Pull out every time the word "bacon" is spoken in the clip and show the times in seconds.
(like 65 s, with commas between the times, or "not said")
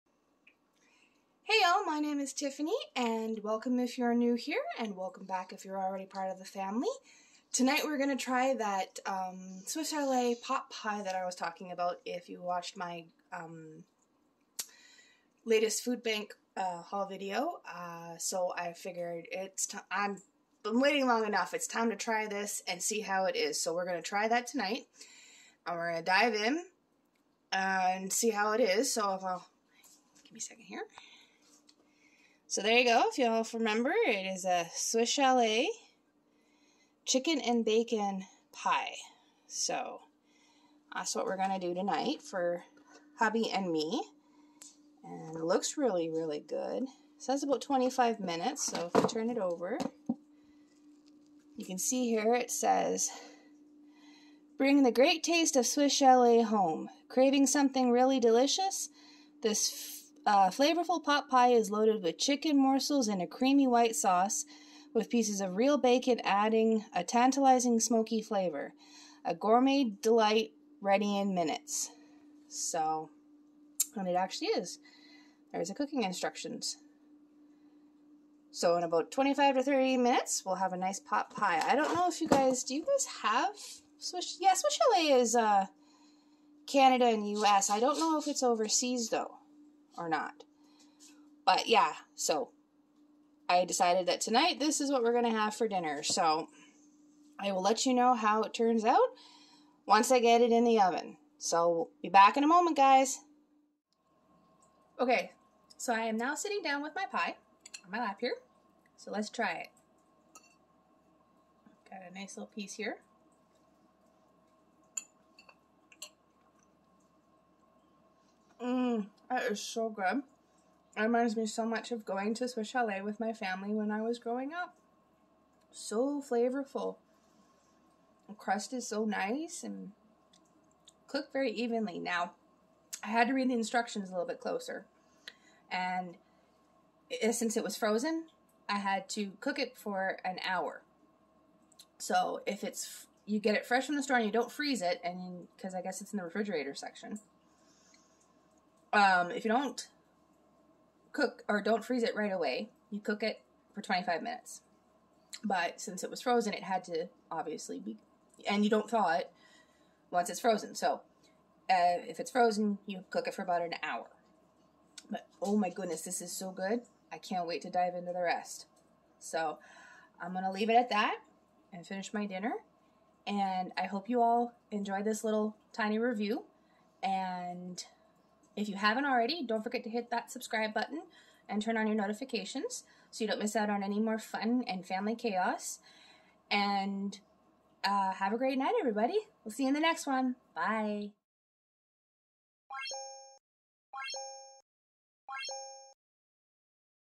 37 s, 65 s.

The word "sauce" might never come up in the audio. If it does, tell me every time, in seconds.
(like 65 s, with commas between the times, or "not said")
63 s.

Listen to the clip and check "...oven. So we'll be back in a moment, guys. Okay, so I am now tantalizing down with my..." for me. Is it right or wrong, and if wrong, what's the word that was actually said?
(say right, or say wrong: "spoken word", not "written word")
wrong: "sitting", not "tantalizing".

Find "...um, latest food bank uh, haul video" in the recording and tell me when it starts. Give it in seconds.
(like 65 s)
13 s.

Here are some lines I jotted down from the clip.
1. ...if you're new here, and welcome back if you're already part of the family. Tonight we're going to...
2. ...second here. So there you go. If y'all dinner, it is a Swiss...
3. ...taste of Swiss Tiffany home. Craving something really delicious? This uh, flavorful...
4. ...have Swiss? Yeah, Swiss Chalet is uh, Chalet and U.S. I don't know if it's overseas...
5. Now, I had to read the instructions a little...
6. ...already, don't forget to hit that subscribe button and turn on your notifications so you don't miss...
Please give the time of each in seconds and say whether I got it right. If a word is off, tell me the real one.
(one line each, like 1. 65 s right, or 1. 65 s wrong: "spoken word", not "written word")
1. 3 s right
2. 30 s wrong: "remember", not "dinner"
3. 55 s wrong: "Chalet", not "Tiffany"
4. 83 s wrong: "Canada", not "Chalet"
5. 131 s right
6. 179 s right.